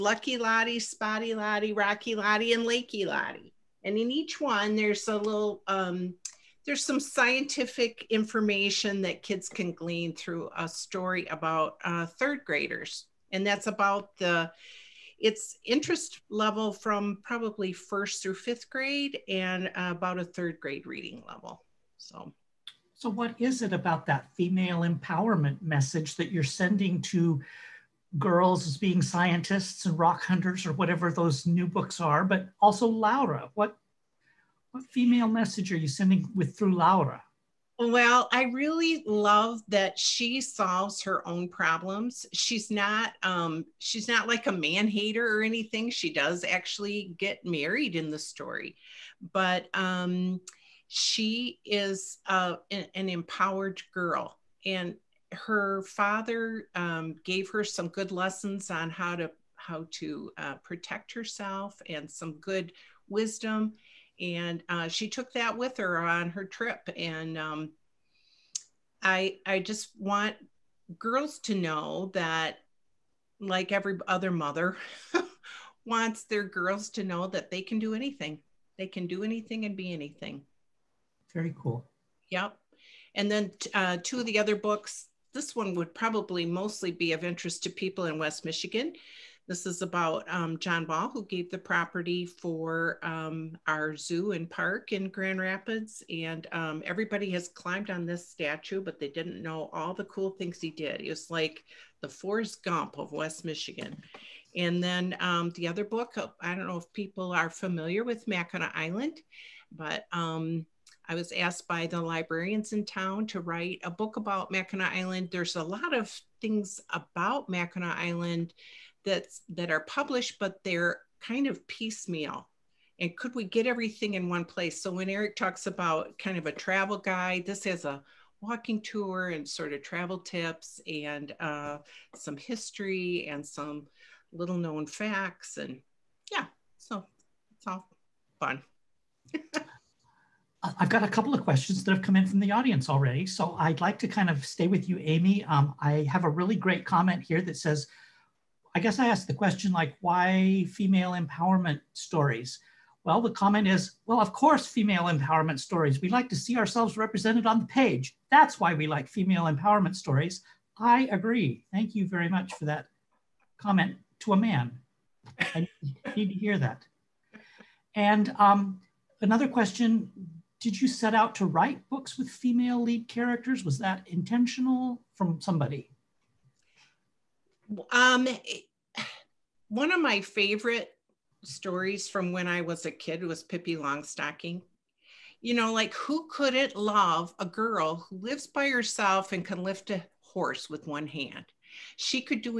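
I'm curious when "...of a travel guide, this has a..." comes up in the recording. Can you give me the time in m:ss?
2:06.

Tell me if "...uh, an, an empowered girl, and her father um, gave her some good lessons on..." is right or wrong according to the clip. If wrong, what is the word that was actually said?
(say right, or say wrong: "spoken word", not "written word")
right.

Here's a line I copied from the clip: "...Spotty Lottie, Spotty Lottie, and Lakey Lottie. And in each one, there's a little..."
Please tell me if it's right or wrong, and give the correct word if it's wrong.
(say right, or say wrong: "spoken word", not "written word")
wrong: "Rocky", not "Spotty".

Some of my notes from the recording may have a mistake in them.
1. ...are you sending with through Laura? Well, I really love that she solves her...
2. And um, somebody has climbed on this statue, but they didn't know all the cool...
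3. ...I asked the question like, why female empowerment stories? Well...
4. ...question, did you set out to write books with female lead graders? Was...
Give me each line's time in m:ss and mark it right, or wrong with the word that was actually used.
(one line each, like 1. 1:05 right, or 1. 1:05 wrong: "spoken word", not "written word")
1. 0:35 right
2. 1:36 wrong: "everybody", not "somebody"
3. 2:28 right
4. 2:49 wrong: "characters", not "graders".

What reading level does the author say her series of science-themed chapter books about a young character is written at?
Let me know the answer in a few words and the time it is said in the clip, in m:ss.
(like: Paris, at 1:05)
third grade, at 0:20.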